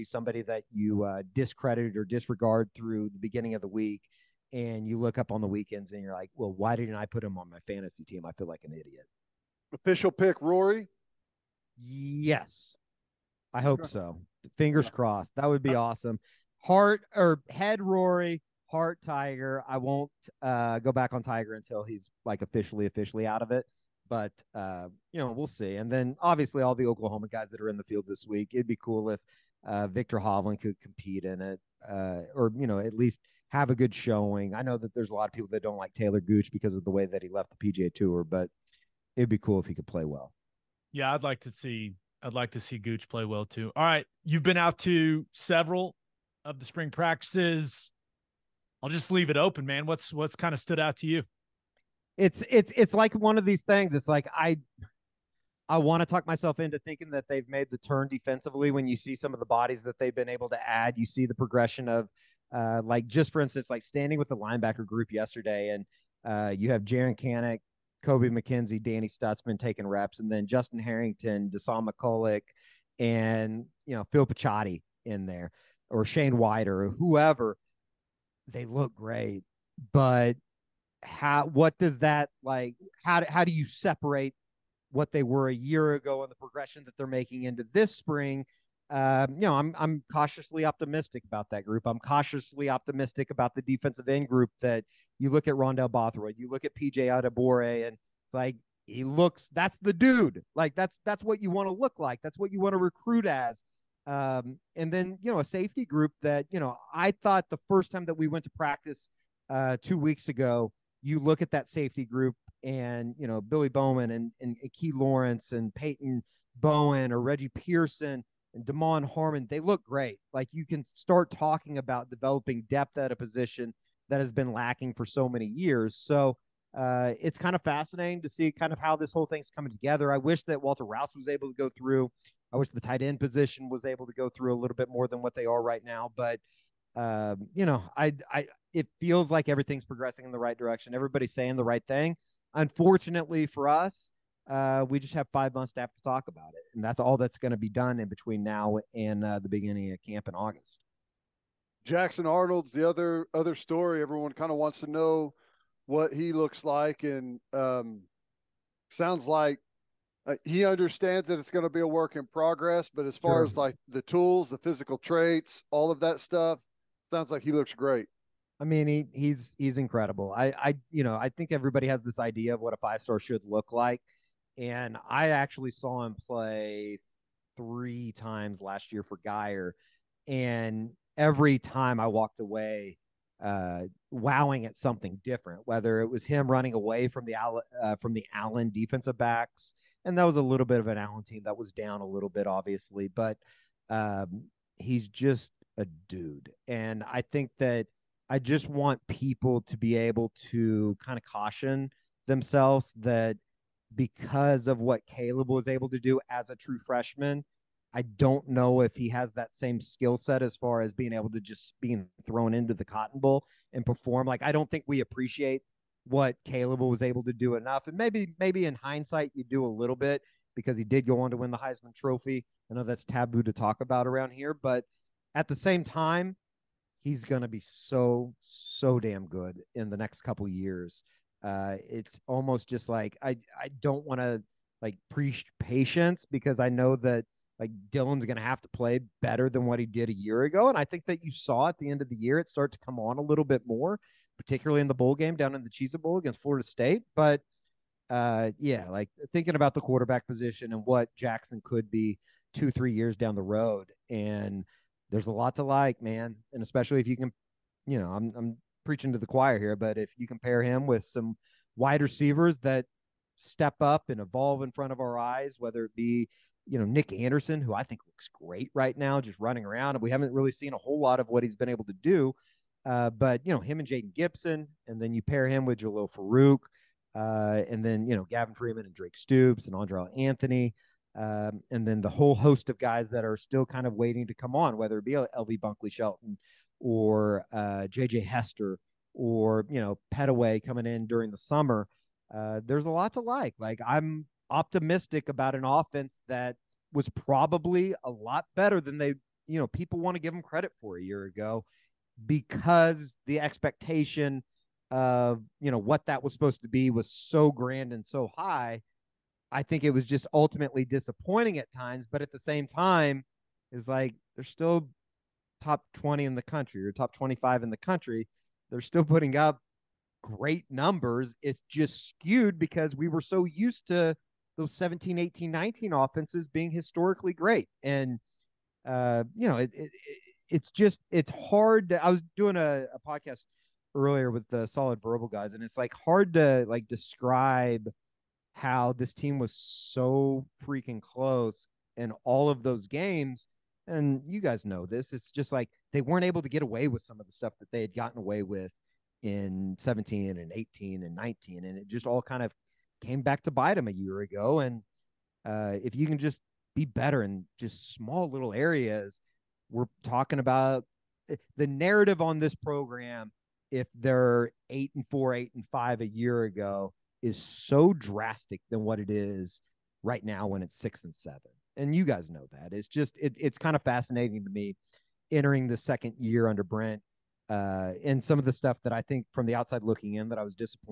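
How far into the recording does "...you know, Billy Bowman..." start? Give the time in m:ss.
1:53.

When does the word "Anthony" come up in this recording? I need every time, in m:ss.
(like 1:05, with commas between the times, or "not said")
4:40.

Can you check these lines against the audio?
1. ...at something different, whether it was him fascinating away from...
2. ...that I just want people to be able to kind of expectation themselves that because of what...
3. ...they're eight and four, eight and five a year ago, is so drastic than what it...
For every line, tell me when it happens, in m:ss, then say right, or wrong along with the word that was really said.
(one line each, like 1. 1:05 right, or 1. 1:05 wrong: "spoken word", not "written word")
1. 3:04 wrong: "running", not "fascinating"
2. 3:17 wrong: "caution", not "expectation"
3. 6:03 right.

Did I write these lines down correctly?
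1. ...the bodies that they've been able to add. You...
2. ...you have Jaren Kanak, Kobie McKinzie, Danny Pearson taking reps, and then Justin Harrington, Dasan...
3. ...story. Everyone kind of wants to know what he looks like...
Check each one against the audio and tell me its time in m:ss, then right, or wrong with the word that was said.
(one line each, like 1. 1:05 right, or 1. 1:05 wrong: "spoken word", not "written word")
1. 0:59 right
2. 1:06 wrong: "Stutsman", not "Pearson"
3. 2:33 right.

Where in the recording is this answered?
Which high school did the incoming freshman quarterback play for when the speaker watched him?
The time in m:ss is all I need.
2:59.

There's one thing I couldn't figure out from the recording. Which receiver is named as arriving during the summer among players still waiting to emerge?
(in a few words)
Pettaway.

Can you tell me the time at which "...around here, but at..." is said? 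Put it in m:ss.
3:44.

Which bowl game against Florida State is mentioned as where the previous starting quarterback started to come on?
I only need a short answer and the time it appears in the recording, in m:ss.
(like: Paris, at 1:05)
Cheez Bowl, at 4:05.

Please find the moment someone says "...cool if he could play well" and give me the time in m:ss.
0:39.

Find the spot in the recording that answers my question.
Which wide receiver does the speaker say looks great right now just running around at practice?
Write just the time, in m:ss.
4:26.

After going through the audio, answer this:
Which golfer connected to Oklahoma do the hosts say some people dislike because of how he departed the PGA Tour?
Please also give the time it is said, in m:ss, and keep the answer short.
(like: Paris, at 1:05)
Taylor Gooch, at 0:35.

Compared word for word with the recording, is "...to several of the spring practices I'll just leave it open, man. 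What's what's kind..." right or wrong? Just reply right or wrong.
right.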